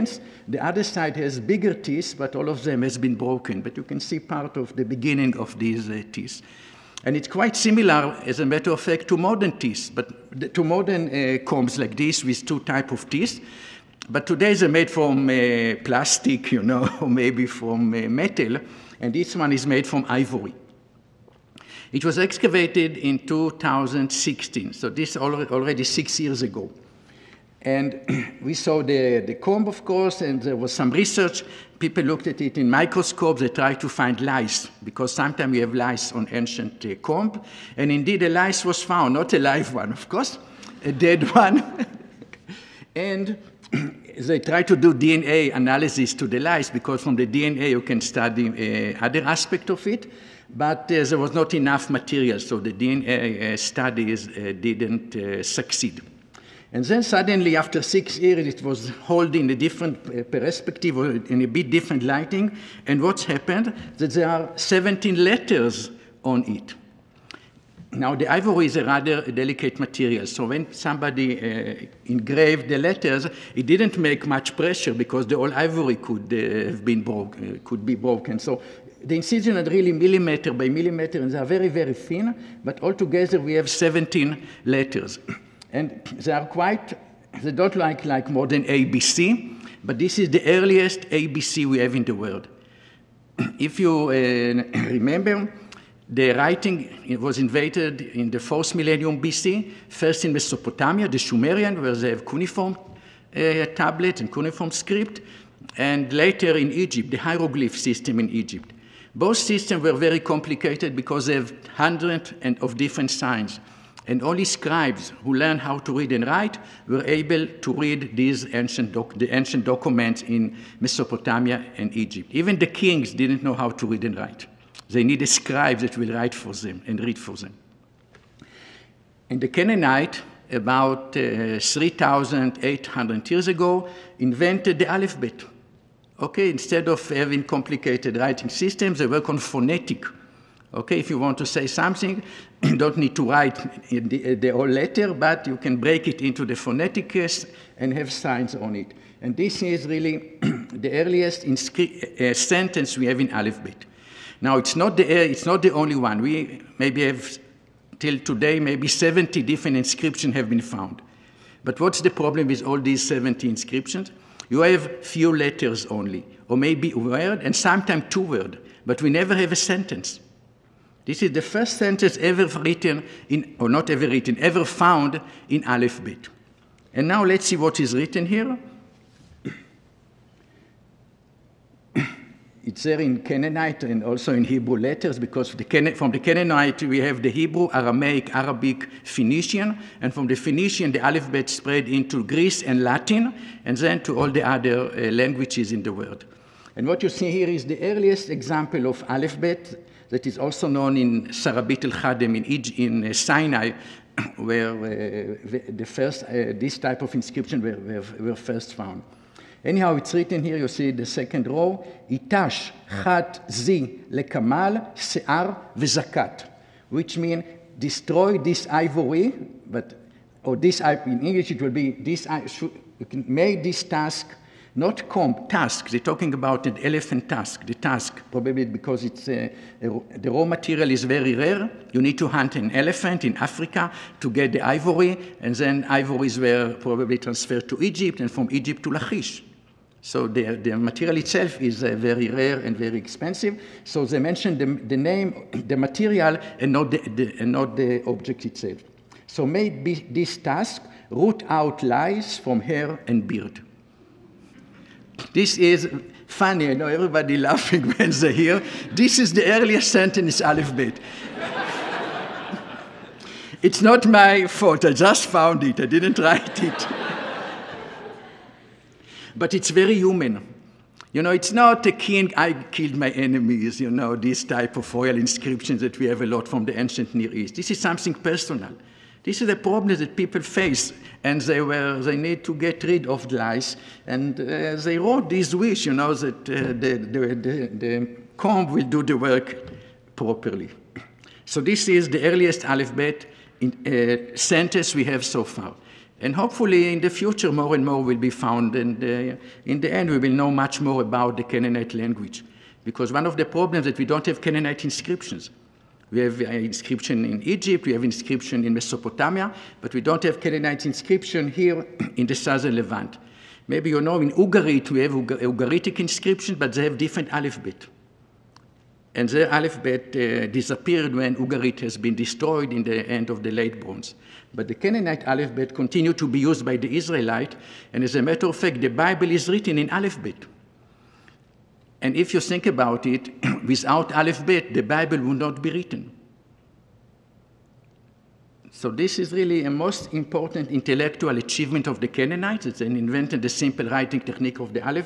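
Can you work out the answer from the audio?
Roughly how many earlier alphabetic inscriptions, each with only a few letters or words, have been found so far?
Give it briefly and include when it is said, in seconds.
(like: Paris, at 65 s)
70, at 158 s.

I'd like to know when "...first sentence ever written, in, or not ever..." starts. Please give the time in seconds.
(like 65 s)
171 s.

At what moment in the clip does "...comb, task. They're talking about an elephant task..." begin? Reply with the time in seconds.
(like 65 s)
225 s.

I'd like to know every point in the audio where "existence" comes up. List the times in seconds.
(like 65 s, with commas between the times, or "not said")
not said.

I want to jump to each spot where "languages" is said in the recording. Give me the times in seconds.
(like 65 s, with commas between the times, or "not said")
195 s, 301 s.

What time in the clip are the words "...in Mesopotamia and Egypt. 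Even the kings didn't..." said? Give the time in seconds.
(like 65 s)
120 s.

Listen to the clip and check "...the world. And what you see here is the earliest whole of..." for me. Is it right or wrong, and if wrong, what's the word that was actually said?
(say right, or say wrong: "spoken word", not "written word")
wrong: "example", not "whole".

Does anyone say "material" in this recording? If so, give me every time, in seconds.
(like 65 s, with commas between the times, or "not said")
51 s, 69 s, 230 s, 240 s, 245 s.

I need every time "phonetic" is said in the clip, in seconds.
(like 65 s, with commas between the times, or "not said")
139 s, 146 s.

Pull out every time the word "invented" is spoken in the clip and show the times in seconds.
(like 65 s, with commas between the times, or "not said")
97 s, 134 s, 342 s.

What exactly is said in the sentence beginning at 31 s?
People looked at it in microscopes.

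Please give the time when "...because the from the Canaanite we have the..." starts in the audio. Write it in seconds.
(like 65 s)
185 s.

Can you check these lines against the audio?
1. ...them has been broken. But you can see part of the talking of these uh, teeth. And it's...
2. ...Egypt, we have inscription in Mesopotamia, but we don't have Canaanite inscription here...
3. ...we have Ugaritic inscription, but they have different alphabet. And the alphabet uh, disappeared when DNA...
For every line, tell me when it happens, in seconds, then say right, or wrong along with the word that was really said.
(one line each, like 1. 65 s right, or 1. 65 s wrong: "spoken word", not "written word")
1. 2 s wrong: "beginning", not "talking"
2. 307 s right
3. 314 s wrong: "Ugarit", not "DNA".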